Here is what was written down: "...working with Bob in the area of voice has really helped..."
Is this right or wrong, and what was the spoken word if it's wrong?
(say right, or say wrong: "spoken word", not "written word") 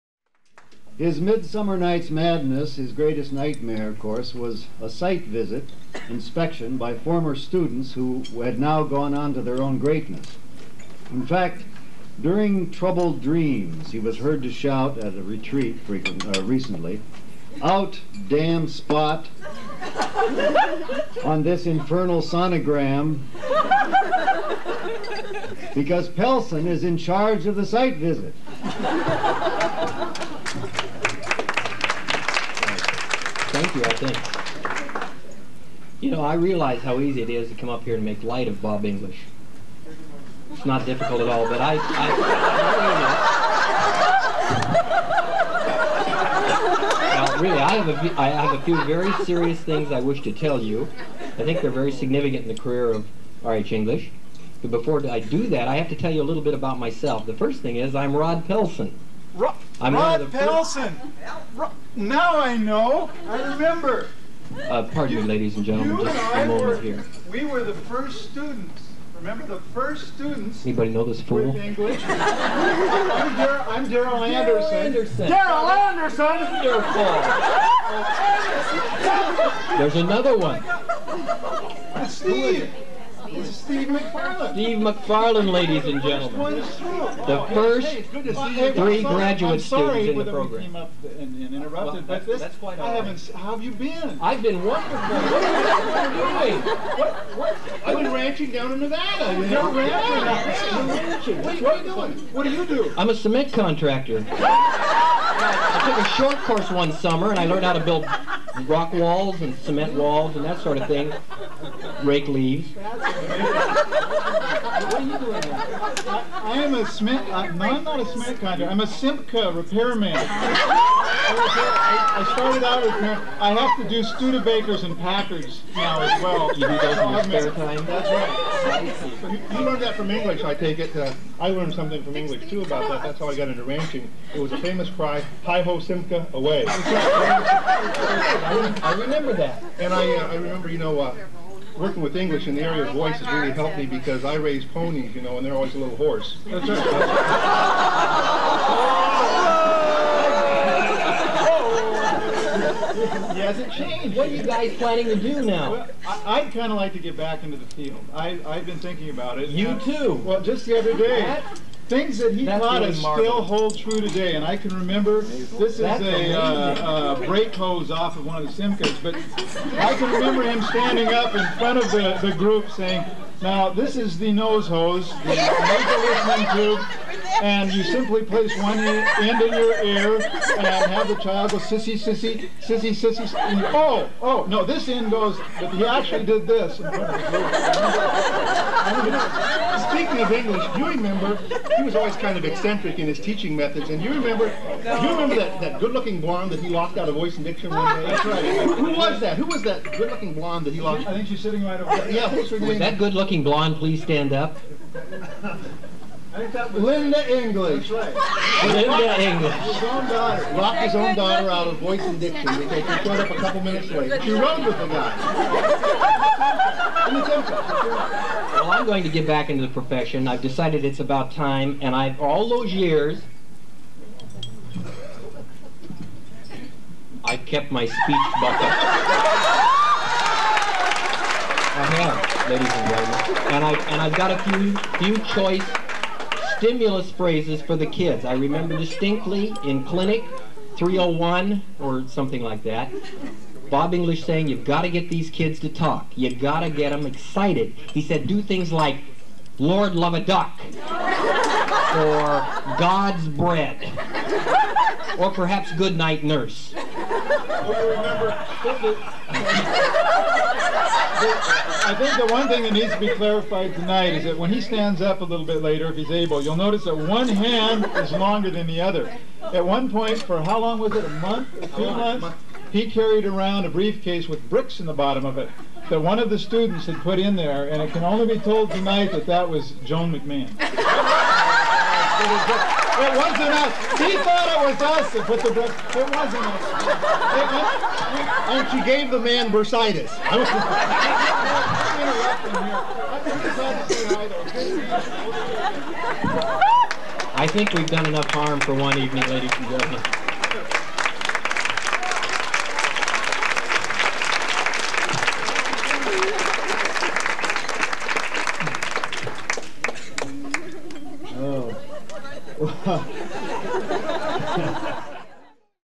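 wrong: "English", not "Bob".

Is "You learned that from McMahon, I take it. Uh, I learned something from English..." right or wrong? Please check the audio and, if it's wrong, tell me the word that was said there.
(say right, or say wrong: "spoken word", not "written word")
wrong: "English", not "McMahon".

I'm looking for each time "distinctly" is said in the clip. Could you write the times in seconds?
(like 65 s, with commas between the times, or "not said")
238 s.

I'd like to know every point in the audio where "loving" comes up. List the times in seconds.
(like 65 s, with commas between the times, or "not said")
not said.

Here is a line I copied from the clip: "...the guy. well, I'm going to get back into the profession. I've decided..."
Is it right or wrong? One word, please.
right.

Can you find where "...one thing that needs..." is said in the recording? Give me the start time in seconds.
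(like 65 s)
262 s.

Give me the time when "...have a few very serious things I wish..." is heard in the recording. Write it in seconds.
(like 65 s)
48 s.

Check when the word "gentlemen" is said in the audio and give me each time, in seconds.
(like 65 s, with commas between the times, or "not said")
65 s, 86 s, 232 s, 299 s.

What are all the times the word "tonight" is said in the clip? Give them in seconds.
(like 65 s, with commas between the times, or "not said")
263 s, 278 s.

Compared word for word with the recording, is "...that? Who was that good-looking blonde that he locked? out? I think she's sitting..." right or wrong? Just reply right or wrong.
right.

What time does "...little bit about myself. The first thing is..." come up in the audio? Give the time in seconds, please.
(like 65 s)
56 s.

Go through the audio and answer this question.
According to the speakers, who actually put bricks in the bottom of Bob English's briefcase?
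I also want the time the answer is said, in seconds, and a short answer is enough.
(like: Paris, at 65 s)
Joan McMahon, at 279 s.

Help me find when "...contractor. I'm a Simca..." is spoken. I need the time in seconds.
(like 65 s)
118 s.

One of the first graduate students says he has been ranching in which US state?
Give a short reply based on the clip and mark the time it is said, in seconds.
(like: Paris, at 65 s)
Nevada, at 98 s.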